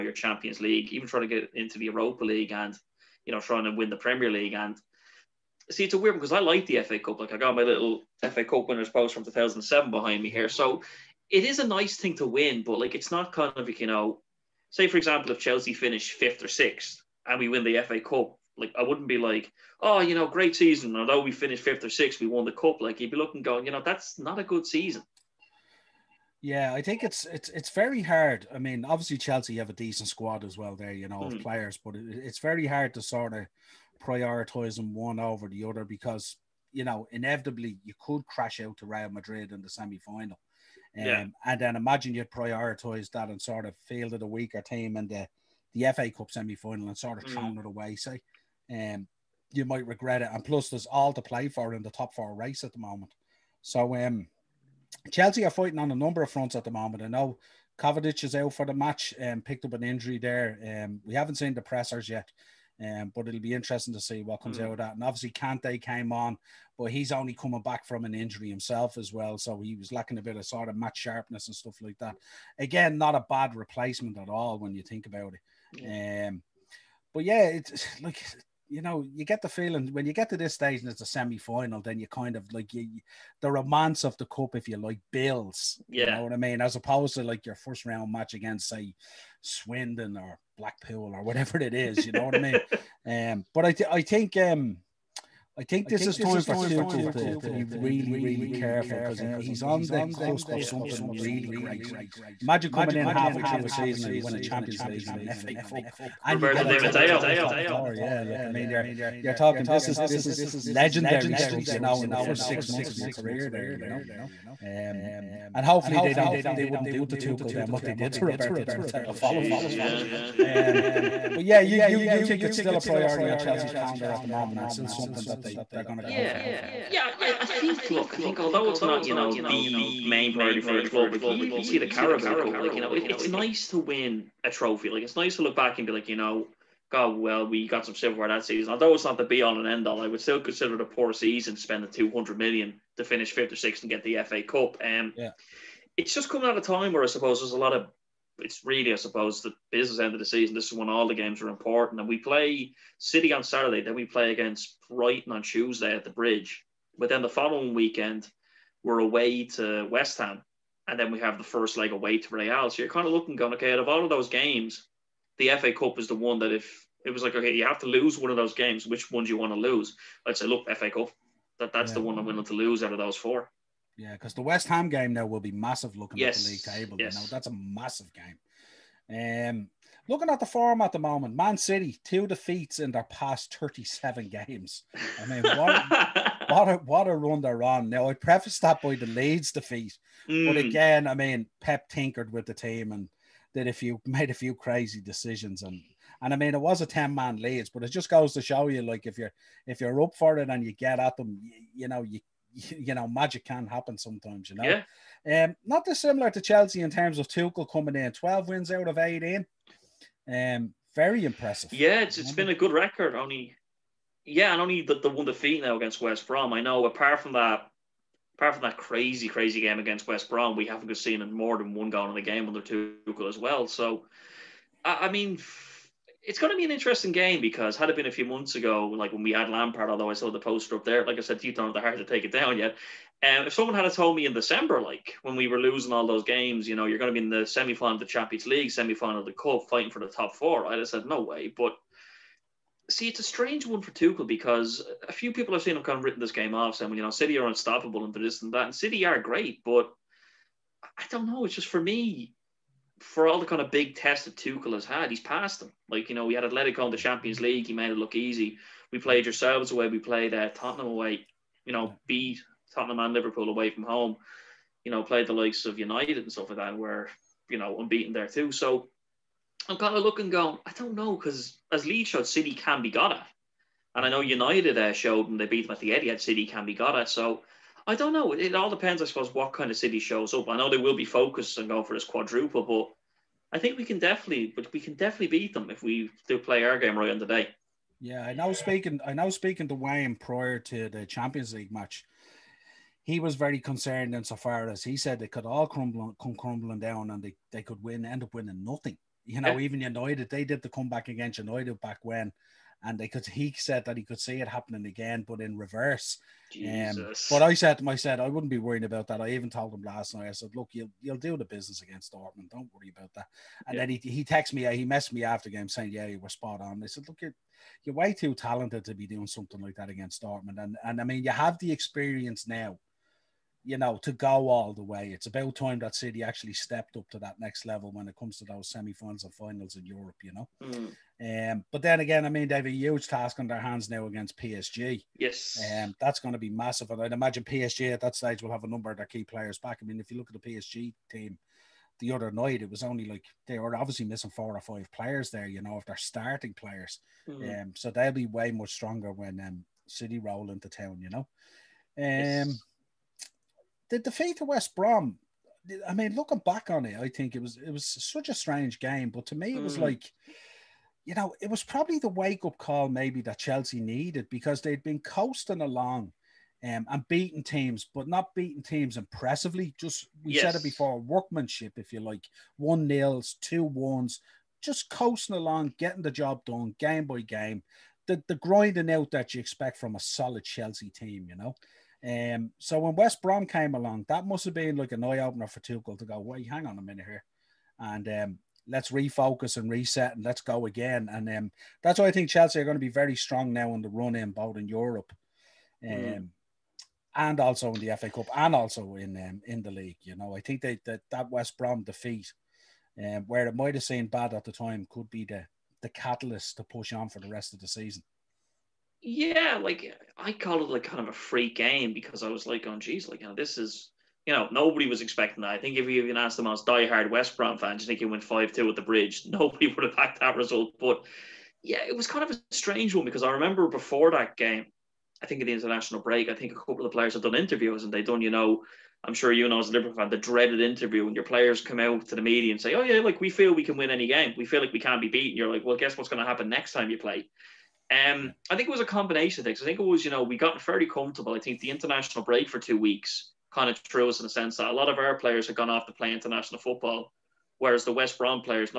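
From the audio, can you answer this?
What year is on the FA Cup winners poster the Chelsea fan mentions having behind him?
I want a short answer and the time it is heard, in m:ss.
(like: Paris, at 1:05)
2007, at 0:09.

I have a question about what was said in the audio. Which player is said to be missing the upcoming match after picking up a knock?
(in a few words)
Kovacic.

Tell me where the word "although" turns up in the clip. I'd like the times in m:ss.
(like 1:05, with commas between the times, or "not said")
0:20, 2:08, 2:18, 3:49.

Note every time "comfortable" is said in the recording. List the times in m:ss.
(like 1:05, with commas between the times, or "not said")
7:20.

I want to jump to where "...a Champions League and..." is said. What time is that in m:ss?
1:44.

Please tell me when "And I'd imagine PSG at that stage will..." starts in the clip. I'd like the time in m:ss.
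5:36.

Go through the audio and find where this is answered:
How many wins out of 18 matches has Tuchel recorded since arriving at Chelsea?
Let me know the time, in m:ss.
3:28.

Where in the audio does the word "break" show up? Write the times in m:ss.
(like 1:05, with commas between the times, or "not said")
7:06, 7:22.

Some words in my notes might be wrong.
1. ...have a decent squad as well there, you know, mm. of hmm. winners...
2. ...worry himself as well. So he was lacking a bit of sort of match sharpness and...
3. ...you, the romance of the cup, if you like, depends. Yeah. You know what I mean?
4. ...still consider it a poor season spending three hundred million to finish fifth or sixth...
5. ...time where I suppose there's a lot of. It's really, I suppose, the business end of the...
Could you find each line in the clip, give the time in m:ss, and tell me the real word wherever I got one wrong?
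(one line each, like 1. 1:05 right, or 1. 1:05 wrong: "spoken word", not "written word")
1. 0:29 wrong: "players", not "winners"
2. 1:08 wrong: "injury", not "worry"
3. 1:22 wrong: "builds", not "depends"
4. 2:20 wrong: "two", not "three"
5. 2:26 right.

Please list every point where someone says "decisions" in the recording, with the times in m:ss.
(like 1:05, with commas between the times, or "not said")
3:15.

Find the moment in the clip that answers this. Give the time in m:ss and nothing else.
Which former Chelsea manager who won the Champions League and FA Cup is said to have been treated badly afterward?
1:58.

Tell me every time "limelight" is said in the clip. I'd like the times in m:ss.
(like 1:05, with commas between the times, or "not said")
not said.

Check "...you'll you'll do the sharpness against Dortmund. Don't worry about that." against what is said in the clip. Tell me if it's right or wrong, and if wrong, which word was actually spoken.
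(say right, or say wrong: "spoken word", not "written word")
wrong: "business", not "sharpness".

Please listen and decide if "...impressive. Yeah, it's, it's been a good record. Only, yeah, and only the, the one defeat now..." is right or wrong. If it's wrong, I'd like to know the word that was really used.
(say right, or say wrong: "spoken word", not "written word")
right.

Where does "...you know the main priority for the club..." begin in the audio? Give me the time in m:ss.
2:09.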